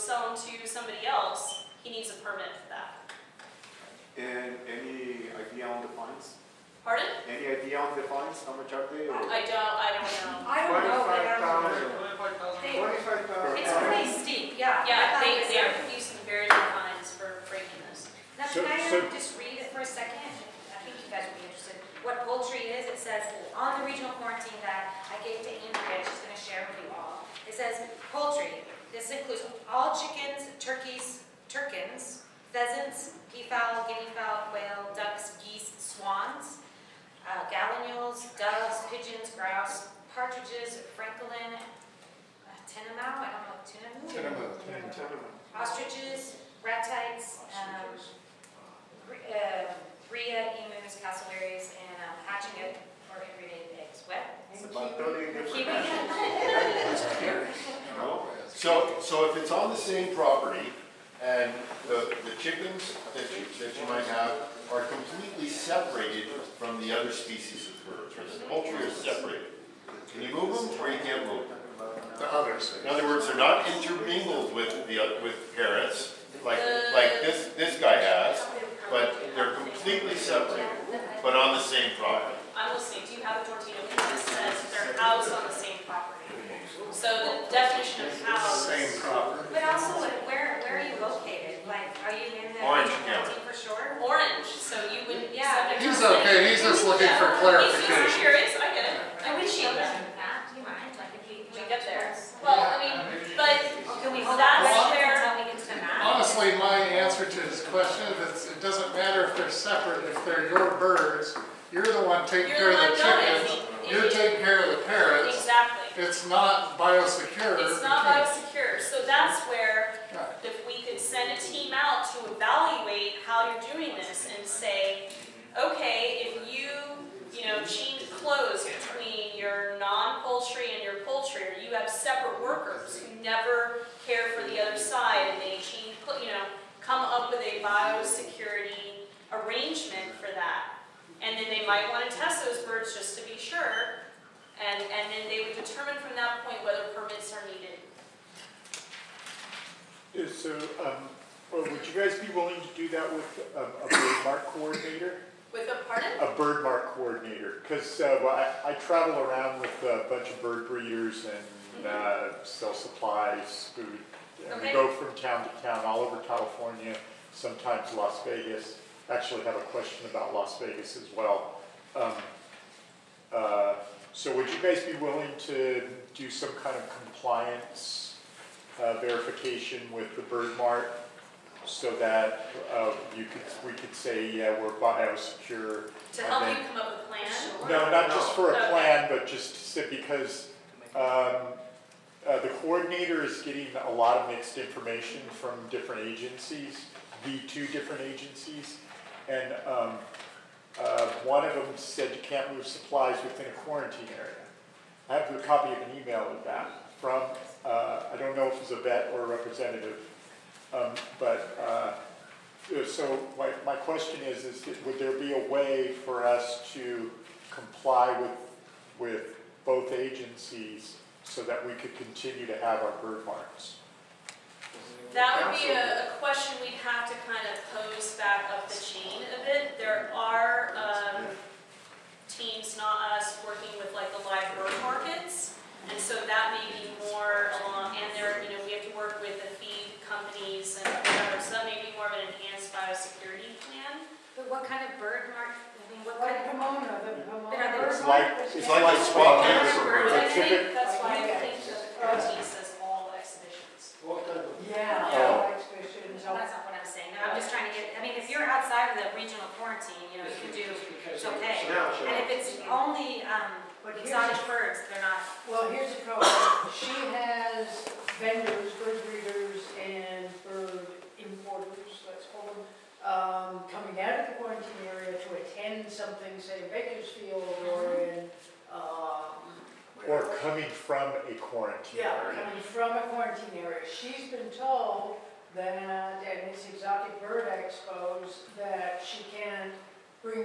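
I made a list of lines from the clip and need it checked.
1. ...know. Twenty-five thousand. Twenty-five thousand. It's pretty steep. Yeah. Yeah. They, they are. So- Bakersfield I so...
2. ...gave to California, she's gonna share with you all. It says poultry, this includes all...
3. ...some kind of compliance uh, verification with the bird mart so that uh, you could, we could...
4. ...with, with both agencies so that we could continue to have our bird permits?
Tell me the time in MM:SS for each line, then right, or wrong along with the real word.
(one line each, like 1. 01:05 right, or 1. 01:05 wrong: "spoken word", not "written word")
1. 00:10 wrong: "Can", not "Bakersfield"
2. 00:25 wrong: "Andrea", not "California"
3. 02:56 right
4. 03:38 wrong: "marts", not "permits".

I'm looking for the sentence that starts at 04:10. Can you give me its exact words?
That's why, I think the OT all exhibitions.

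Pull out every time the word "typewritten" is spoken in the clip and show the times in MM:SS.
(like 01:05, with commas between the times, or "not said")
not said.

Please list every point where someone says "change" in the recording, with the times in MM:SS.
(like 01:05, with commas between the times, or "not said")
02:07, 02:15.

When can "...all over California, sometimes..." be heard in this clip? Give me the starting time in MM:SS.
02:45.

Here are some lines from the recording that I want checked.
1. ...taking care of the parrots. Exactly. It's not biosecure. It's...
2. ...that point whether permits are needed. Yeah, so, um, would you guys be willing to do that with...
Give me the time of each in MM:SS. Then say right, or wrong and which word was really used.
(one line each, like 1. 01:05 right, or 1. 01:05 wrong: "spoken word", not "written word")
1. 01:54 right
2. 02:26 right.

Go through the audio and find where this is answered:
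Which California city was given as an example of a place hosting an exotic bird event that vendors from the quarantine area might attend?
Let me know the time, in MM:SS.
04:36.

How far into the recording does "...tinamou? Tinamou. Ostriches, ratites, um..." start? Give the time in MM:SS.
00:43.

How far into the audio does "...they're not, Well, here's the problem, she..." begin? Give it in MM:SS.
04:24.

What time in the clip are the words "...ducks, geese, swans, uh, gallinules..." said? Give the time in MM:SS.
00:34.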